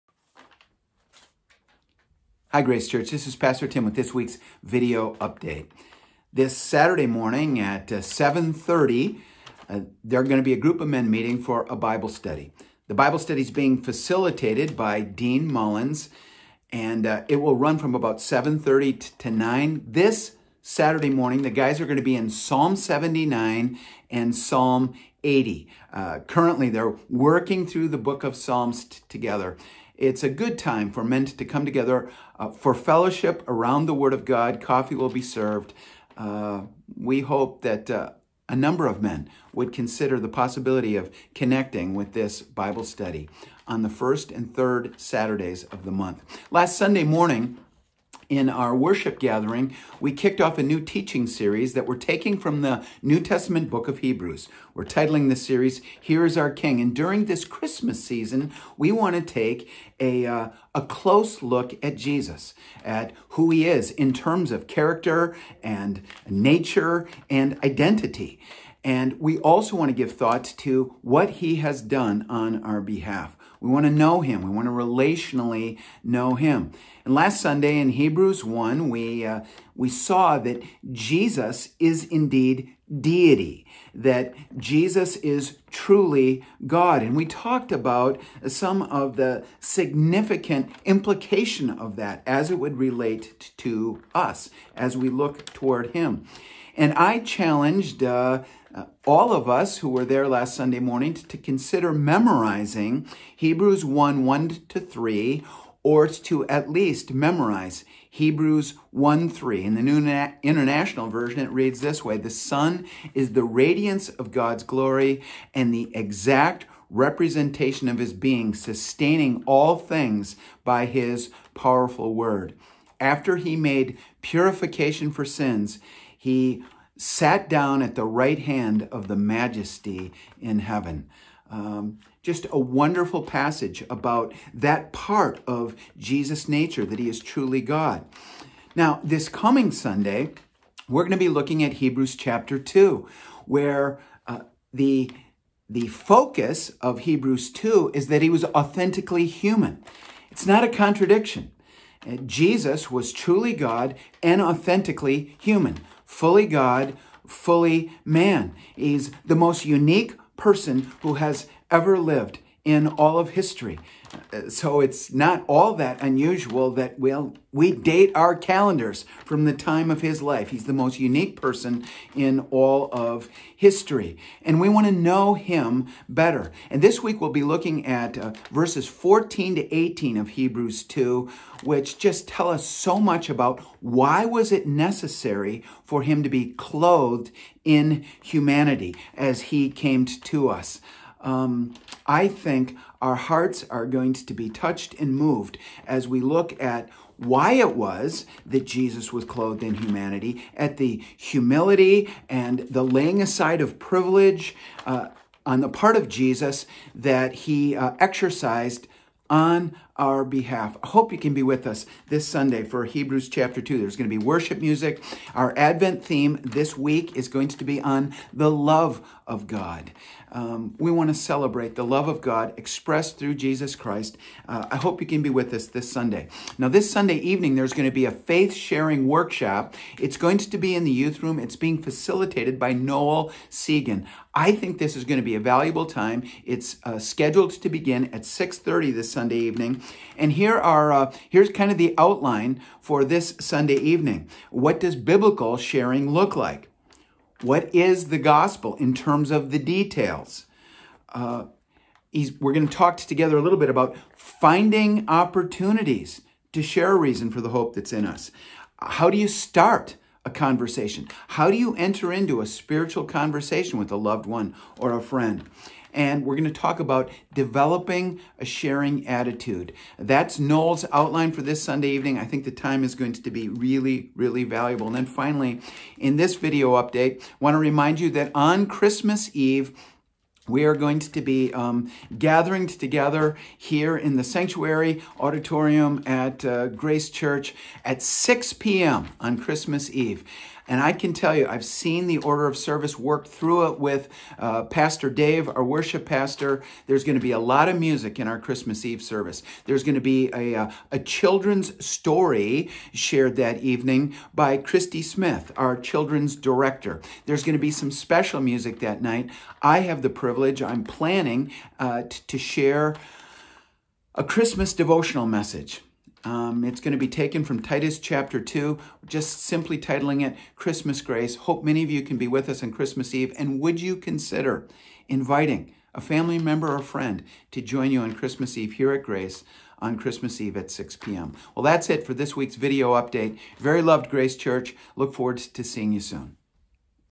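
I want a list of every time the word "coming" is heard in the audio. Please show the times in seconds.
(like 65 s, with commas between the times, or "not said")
139 s.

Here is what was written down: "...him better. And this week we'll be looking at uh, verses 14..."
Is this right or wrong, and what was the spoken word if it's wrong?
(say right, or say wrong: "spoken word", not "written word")
right.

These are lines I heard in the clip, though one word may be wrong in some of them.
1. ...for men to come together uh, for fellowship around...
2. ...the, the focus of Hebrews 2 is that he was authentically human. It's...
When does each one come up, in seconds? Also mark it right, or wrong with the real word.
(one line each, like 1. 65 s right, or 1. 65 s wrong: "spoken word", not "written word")
1. 30 s right
2. 144 s right.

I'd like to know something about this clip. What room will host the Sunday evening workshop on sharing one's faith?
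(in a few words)
the youth room.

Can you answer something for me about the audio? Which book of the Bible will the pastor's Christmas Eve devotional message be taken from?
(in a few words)
Titus.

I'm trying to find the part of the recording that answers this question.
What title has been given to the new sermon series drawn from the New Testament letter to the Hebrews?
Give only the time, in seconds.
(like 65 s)
55 s.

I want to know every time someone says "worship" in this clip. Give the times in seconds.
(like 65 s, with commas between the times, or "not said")
48 s, 214 s, 295 s.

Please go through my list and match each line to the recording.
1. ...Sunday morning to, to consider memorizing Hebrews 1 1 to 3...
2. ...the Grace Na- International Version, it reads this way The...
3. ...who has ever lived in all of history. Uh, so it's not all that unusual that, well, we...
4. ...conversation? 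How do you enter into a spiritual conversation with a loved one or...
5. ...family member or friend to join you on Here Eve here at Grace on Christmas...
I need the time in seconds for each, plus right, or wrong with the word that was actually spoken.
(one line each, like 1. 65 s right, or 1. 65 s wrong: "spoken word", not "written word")
1. 100 s right
2. 109 s wrong: "New", not "Grace"
3. 161 s right
4. 260 s right
5. 326 s wrong: "Christmas", not "Here".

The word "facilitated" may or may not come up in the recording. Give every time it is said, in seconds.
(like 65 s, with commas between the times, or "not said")
13 s, 231 s.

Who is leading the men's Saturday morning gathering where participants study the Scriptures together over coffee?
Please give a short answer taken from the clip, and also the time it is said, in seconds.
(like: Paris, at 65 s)
Dean Mullins, at 14 s.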